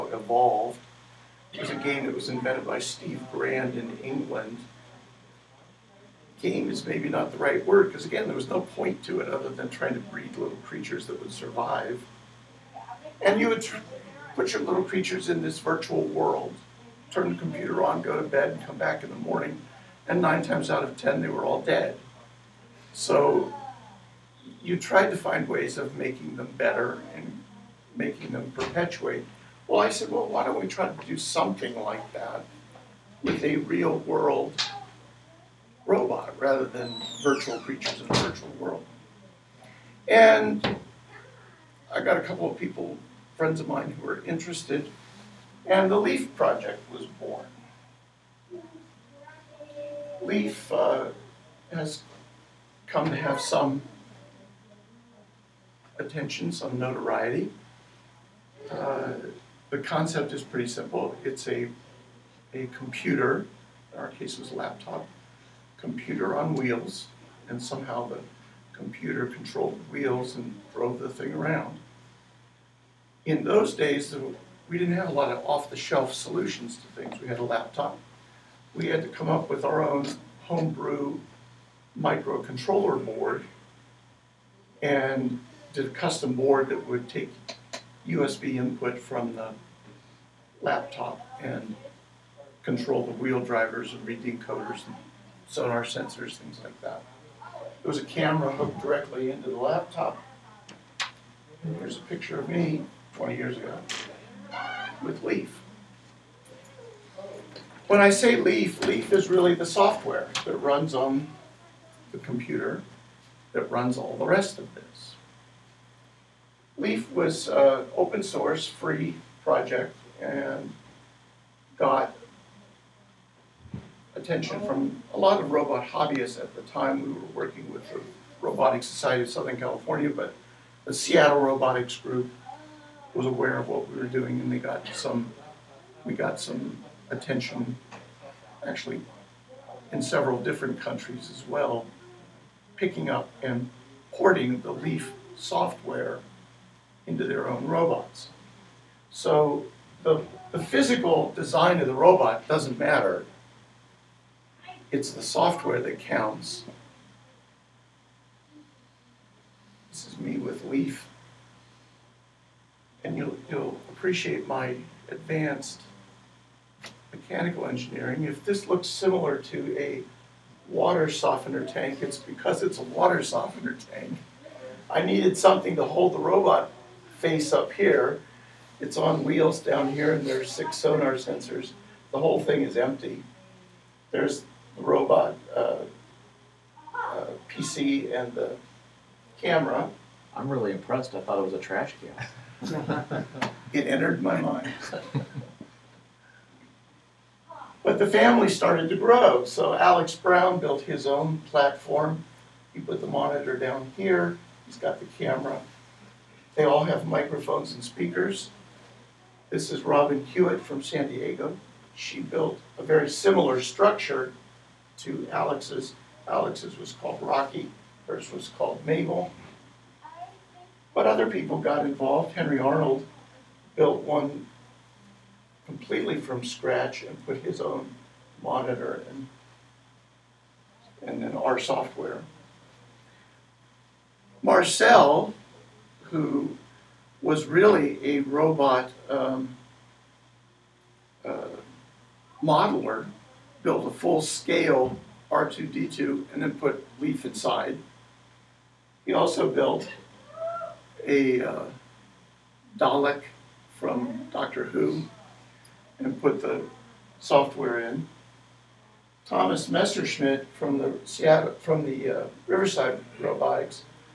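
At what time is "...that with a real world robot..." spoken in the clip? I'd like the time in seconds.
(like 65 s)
32 s.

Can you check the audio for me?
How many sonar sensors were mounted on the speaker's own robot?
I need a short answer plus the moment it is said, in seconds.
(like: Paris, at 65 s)
6, at 180 s.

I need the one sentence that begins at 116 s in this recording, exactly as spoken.
Leaf was uh, open source, free project, and got attention from a lot of robot hobbyists at the time.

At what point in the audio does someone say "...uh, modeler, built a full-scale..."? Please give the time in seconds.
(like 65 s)
241 s.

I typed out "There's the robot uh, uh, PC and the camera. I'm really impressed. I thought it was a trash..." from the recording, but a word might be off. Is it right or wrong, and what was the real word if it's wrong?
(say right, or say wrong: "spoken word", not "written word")
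right.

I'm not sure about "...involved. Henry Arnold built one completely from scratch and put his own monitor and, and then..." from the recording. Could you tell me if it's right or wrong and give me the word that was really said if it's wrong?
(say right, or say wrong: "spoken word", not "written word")
right.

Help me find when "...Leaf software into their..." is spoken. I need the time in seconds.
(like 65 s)
144 s.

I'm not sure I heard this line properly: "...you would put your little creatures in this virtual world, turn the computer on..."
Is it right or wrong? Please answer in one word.
right.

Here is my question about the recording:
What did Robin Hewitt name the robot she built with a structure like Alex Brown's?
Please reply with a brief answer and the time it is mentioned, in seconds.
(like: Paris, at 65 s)
Mabel, at 218 s.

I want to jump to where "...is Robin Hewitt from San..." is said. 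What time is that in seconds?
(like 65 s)
209 s.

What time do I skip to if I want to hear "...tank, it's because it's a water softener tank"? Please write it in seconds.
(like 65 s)
171 s.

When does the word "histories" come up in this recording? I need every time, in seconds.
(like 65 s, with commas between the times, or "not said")
not said.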